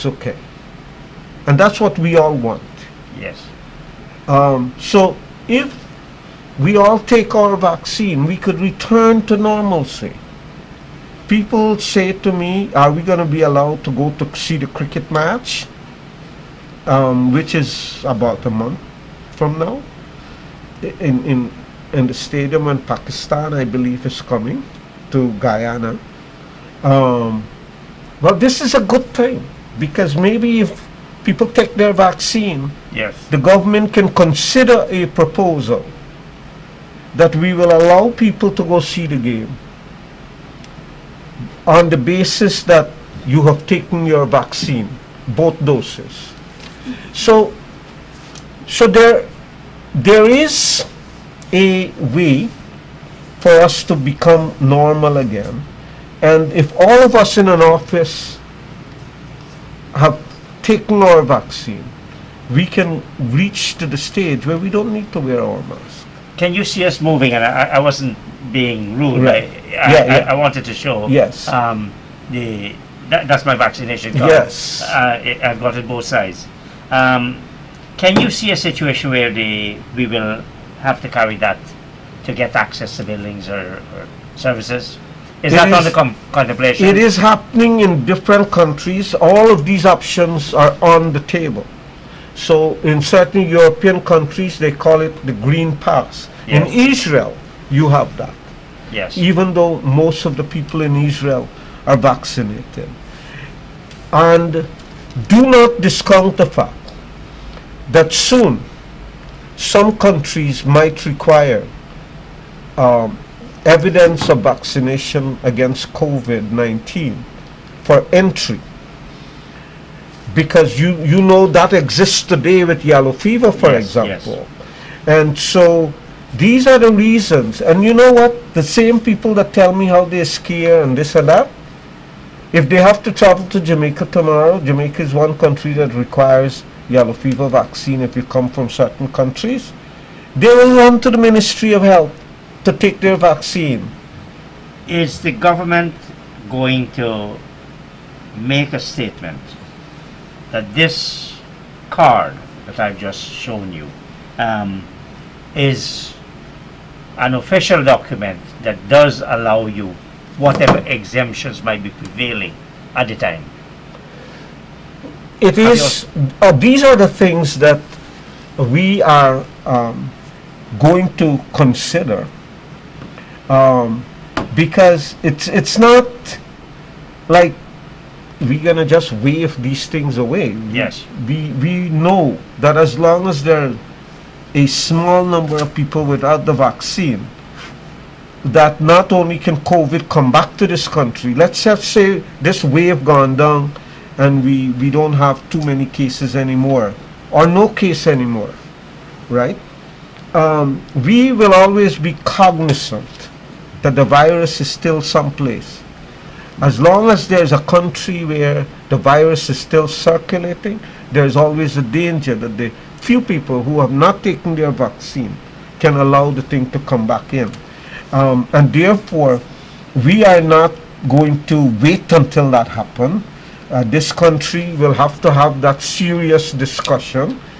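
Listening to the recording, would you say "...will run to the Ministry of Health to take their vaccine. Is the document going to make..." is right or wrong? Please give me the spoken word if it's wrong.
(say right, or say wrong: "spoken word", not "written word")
wrong: "government", not "document".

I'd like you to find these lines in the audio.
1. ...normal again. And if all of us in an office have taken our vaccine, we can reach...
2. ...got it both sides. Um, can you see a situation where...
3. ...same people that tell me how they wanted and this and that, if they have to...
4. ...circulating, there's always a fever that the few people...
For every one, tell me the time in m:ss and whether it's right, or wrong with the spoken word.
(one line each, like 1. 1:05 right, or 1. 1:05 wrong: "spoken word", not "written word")
1. 0:54 right
2. 1:15 right
3. 2:08 wrong: "scared", not "wanted"
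4. 3:29 wrong: "danger", not "fever".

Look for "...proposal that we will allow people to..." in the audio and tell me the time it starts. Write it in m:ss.
0:35.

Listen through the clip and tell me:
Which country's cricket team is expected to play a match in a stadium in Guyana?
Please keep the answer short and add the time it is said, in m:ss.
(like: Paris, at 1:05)
Pakistan, at 0:22.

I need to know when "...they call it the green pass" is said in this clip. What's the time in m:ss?
1:34.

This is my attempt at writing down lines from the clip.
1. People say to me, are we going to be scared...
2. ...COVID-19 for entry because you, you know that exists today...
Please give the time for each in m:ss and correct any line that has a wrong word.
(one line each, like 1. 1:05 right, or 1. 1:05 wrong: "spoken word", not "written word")
1. 0:11 wrong: "allowed", not "scared"
2. 1:55 right.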